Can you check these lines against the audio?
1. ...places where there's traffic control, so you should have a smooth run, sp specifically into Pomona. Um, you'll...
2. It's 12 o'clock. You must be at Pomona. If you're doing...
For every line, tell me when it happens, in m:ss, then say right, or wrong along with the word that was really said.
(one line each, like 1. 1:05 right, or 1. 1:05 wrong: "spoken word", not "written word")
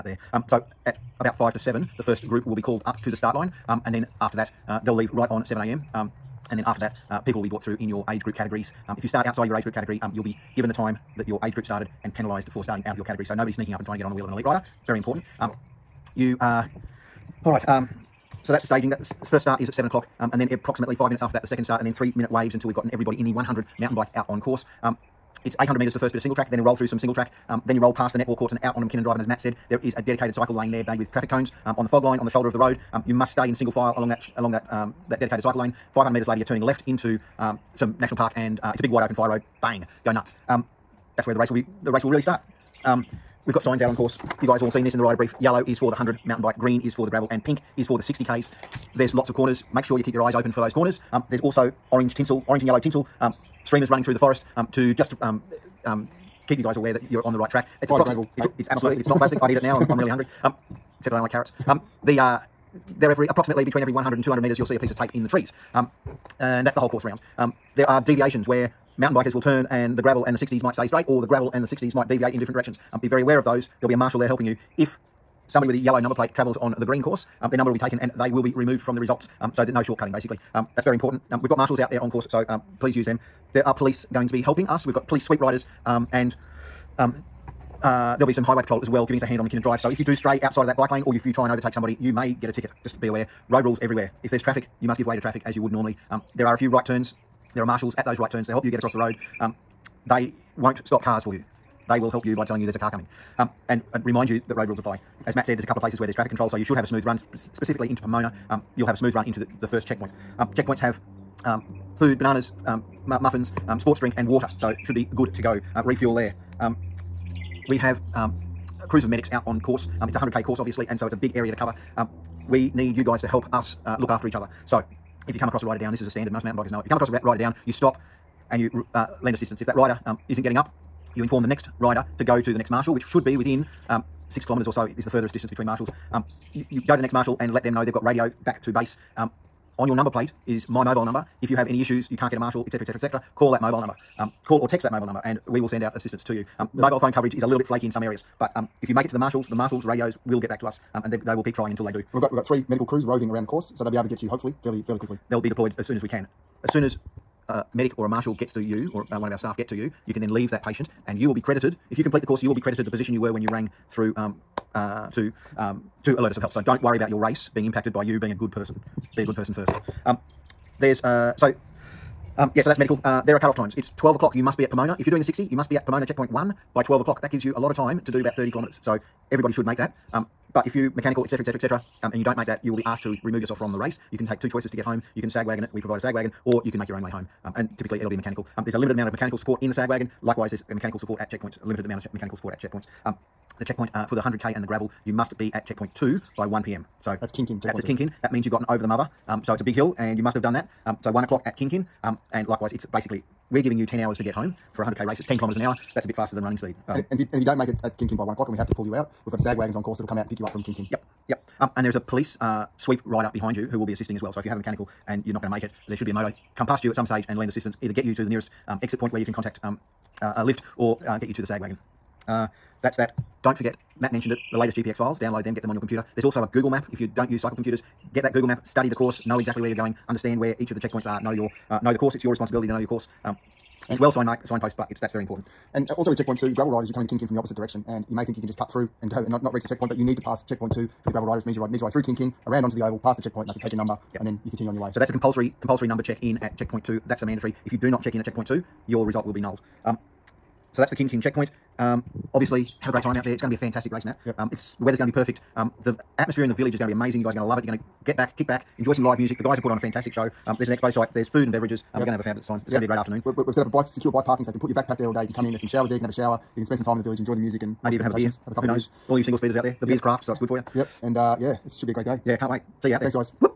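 1. 1:45 right
2. 2:53 right.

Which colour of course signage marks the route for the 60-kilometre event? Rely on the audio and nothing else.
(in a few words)
pink.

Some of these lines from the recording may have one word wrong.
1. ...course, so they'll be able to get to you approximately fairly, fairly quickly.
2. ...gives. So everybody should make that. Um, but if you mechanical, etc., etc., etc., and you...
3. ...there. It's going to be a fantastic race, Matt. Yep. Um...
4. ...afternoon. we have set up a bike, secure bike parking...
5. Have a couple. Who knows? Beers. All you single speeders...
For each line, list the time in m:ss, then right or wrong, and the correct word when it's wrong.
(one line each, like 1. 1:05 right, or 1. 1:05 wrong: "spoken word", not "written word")
1. 2:33 wrong: "hopefully", not "approximately"
2. 2:58 wrong: "kilometres", not "gives"
3. 4:13 right
4. 4:22 right
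5. 4:28 right.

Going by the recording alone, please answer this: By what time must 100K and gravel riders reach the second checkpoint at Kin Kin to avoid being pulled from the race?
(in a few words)
1 p.m.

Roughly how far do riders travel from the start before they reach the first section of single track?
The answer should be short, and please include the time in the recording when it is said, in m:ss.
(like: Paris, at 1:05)
800 metres, at 0:25.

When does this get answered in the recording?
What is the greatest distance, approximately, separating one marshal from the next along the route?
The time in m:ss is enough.
2:14.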